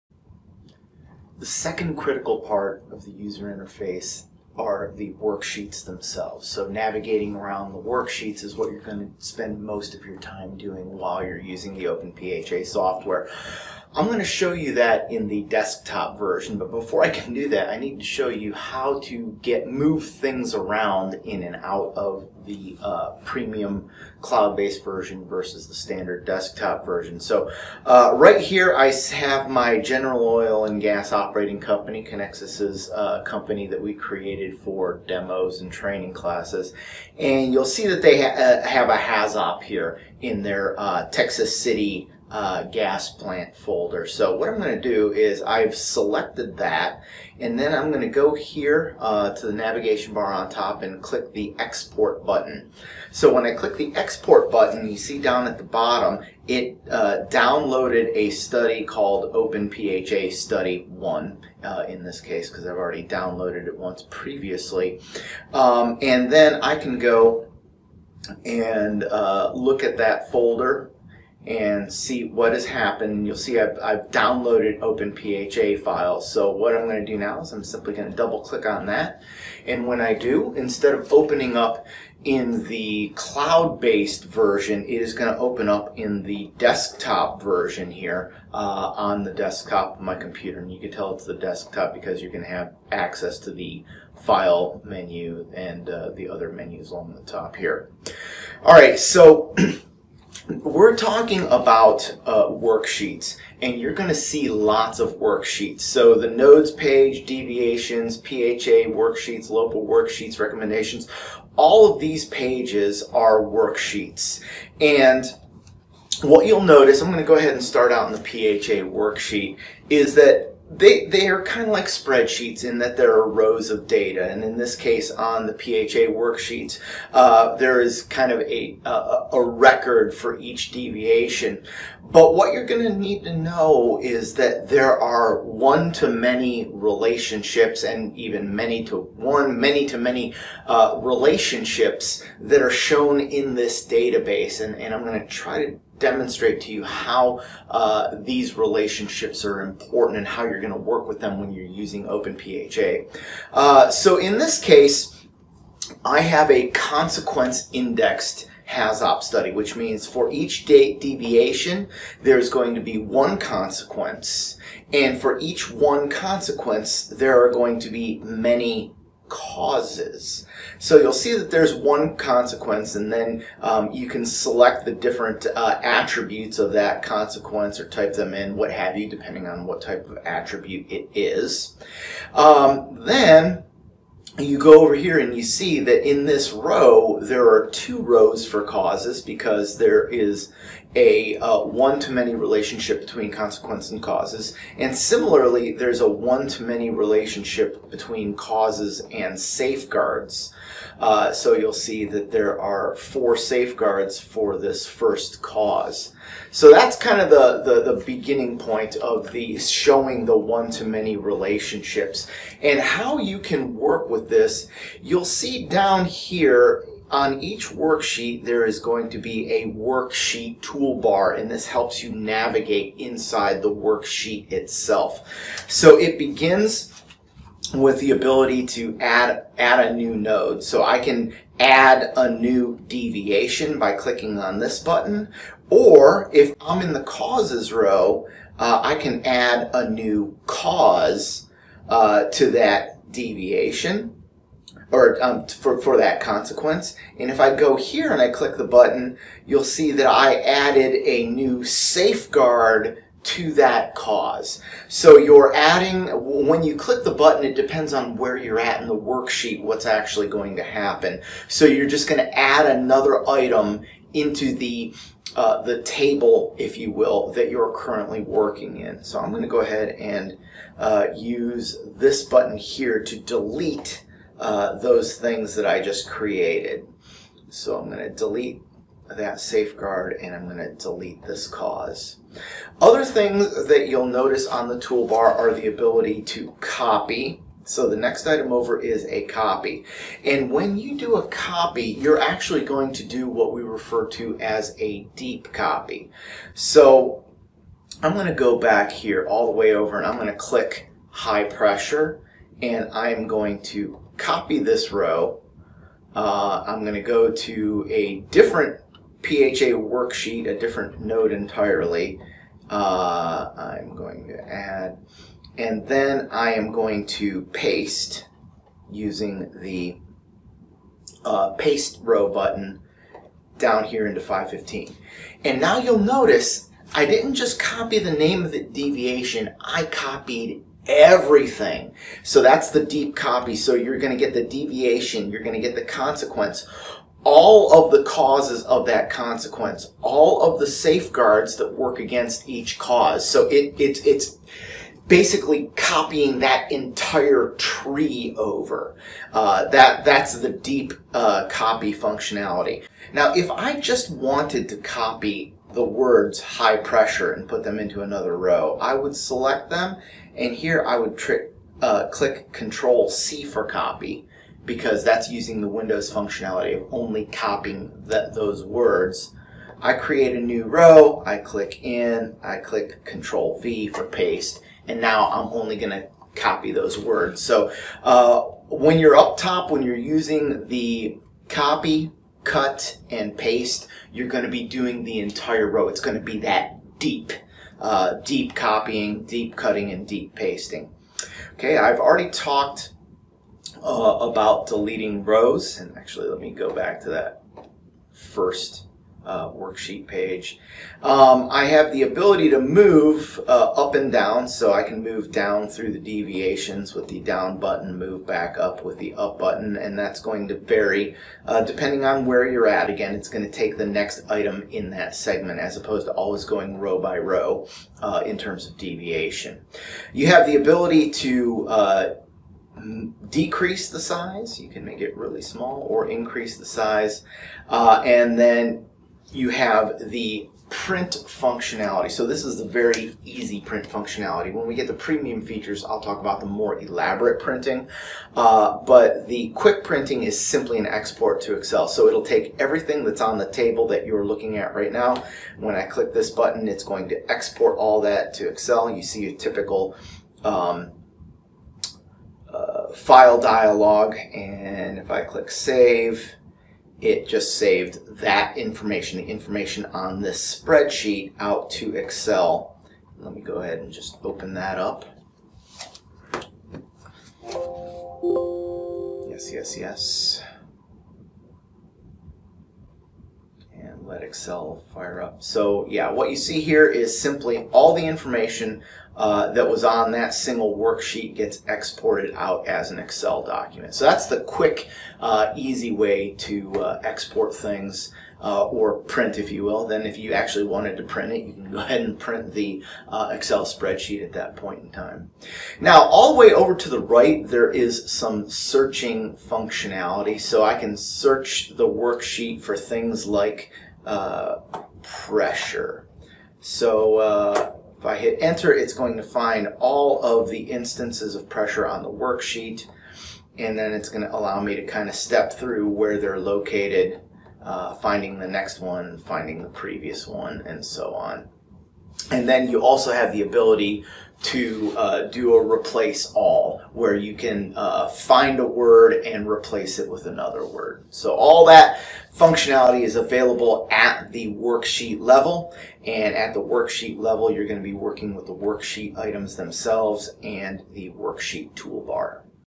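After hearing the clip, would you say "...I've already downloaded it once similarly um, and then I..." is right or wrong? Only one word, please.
wrong.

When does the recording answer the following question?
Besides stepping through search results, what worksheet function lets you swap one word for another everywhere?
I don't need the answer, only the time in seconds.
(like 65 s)
525 s.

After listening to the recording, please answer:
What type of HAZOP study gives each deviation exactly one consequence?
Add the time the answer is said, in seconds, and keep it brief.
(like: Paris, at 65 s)
Consequence indexed, at 156 s.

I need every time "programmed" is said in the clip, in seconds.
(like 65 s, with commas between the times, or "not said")
not said.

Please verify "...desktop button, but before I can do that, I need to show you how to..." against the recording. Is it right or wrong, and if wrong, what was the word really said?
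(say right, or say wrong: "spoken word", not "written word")
wrong: "version", not "button".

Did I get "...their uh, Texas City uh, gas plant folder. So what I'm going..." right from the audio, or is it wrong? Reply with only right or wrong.
right.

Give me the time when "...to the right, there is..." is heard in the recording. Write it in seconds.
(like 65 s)
496 s.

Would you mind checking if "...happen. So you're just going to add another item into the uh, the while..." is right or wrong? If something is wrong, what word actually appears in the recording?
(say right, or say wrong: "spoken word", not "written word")
wrong: "table", not "while".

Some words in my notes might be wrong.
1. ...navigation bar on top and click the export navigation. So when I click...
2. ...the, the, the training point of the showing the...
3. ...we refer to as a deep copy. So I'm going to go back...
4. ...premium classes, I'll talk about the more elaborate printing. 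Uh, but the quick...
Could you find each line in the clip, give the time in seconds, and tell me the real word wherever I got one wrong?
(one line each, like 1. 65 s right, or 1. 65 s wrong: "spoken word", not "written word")
1. 49 s wrong: "button", not "navigation"
2. 207 s wrong: "beginning", not "training"
3. 293 s right
4. 434 s wrong: "features", not "classes".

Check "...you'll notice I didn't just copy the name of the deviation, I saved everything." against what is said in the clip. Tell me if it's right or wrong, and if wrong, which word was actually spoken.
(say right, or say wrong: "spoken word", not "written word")
wrong: "copied", not "saved".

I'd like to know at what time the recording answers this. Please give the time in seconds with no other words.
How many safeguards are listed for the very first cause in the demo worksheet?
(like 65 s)
202 s.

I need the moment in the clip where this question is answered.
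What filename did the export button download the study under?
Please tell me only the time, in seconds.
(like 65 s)
59 s.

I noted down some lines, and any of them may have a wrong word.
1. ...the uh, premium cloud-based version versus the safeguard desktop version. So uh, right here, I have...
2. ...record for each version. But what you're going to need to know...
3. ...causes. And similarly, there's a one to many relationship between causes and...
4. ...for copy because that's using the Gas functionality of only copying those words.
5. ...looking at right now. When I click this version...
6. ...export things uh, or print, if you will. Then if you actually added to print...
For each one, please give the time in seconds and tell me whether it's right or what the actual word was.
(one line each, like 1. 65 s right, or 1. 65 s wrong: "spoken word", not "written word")
1. 22 s wrong: "standard", not "safeguard"
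2. 129 s wrong: "deviation", not "version"
3. 194 s right
4. 363 s wrong: "Windows", not "Gas"
5. 444 s wrong: "button", not "version"
6. 487 s wrong: "wanted", not "added".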